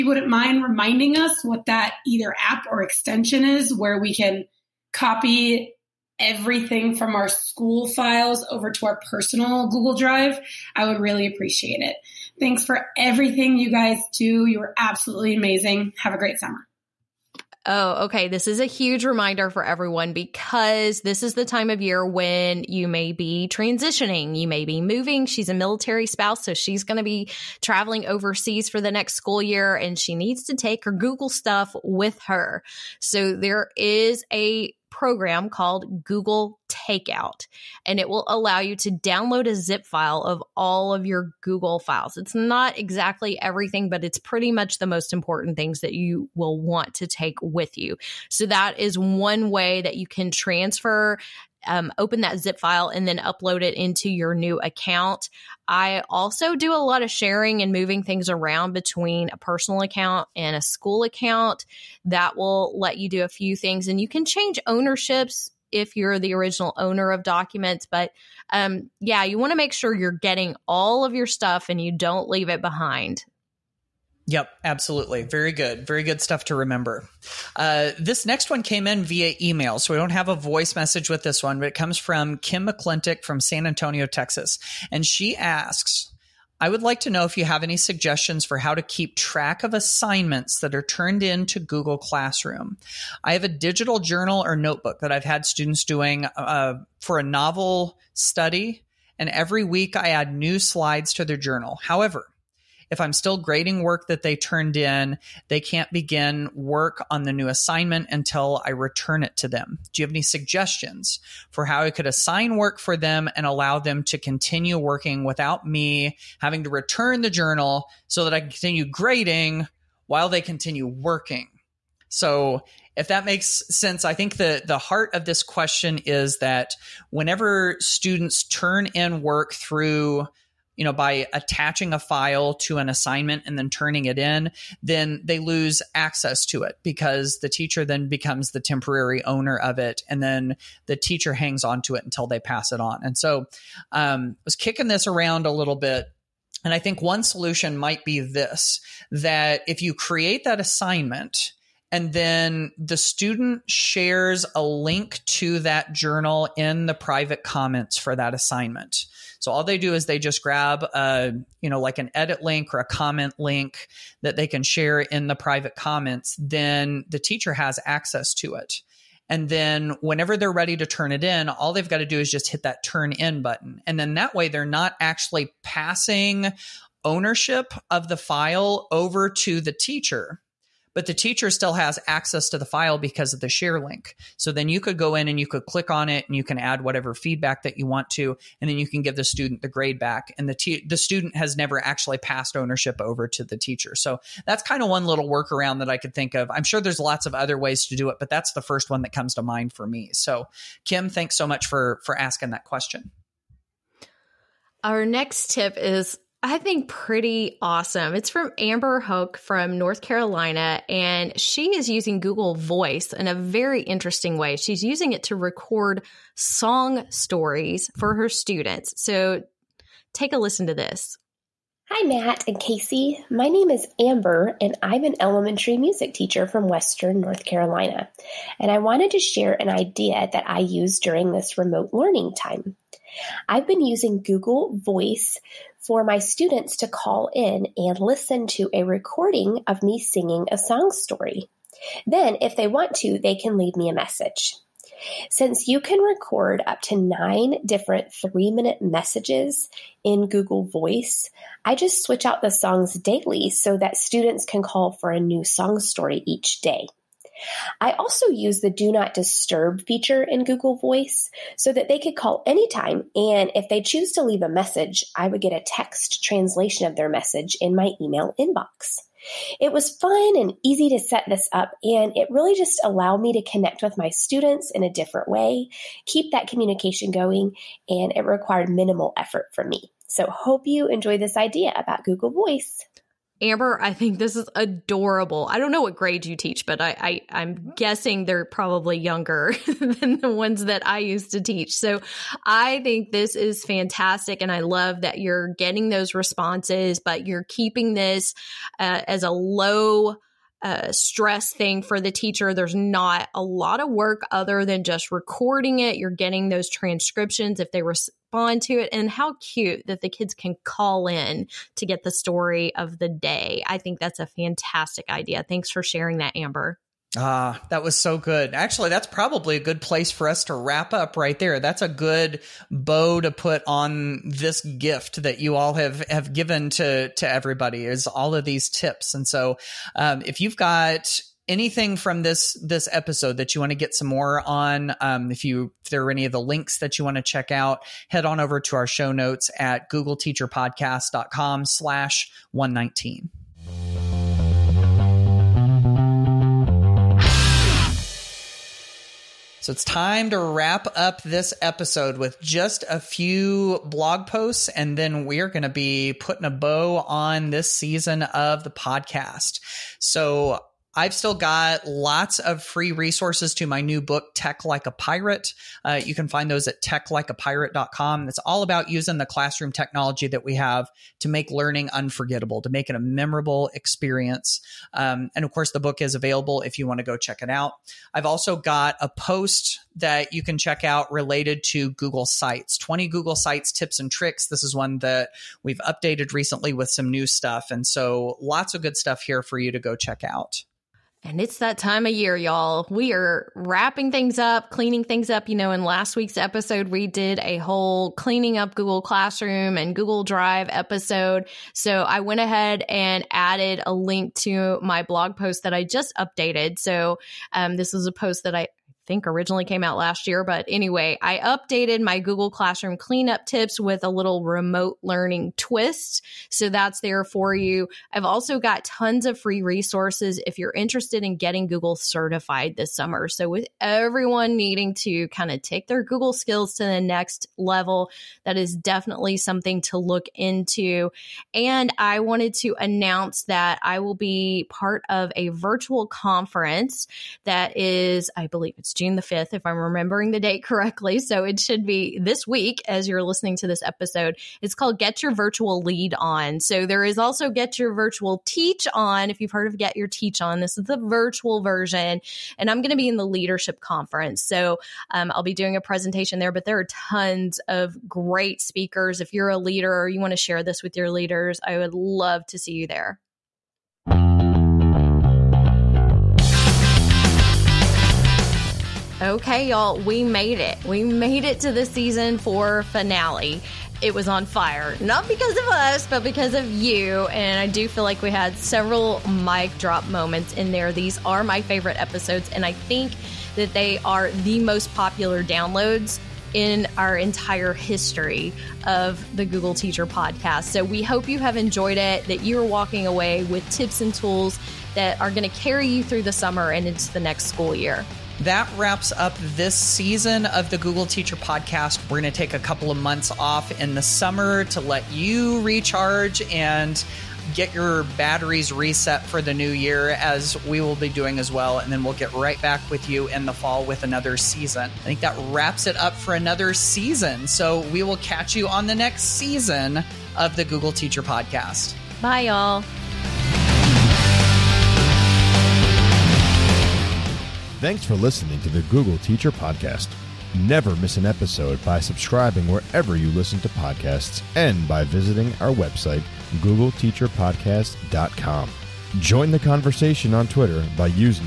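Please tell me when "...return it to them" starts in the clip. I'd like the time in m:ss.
1:48.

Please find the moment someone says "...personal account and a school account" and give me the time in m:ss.
0:59.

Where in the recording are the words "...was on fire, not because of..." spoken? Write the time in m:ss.
7:54.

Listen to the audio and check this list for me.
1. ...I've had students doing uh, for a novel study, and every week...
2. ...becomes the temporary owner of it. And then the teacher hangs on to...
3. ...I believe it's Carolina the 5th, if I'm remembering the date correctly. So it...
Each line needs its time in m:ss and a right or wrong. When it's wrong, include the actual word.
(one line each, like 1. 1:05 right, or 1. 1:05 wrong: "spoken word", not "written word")
1. 1:35 right
2. 2:18 right
3. 7:18 wrong: "June", not "Carolina".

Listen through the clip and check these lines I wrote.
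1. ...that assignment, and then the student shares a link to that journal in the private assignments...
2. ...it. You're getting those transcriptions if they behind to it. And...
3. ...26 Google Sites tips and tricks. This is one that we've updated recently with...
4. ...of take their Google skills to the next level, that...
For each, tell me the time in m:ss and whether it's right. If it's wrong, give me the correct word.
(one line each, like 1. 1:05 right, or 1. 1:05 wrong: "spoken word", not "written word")
1. 2:30 wrong: "comments", not "assignments"
2. 5:05 wrong: "respond", not "behind"
3. 6:22 wrong: "20", not "26"
4. 7:05 right.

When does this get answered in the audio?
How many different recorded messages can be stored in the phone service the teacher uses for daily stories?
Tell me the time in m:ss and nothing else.
4:06.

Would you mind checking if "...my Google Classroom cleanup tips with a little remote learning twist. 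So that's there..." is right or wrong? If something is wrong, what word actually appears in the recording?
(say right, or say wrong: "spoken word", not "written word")
right.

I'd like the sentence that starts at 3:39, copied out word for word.
So take a listen to this.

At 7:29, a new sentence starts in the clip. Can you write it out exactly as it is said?
If you've heard of Get Your Teach On, this is the virtual version.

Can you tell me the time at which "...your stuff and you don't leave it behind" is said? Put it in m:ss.
1:11.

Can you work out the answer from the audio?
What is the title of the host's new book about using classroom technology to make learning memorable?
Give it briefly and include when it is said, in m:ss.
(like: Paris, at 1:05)
Tech Like a Pirate, at 6:04.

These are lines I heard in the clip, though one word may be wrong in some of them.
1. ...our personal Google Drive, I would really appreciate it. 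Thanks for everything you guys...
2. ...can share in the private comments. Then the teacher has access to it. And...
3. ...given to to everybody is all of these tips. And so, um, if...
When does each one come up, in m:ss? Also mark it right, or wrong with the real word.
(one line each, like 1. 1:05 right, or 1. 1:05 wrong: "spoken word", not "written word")
1. 0:08 right
2. 2:44 right
3. 5:26 right.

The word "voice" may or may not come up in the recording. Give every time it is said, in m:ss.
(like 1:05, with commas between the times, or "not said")
1:20, 3:32, 3:54, 4:10, 4:20, 4:42.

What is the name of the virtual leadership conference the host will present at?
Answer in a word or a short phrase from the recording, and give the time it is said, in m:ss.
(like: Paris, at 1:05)
Get Your Virtual Lead On, at 7:24.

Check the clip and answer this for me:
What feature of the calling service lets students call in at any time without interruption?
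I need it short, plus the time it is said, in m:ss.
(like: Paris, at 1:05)
do not disturb, at 4:18.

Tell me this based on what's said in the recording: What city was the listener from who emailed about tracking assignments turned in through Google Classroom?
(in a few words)
San Antonio.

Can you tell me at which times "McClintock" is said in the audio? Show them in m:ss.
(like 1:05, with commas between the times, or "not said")
1:22.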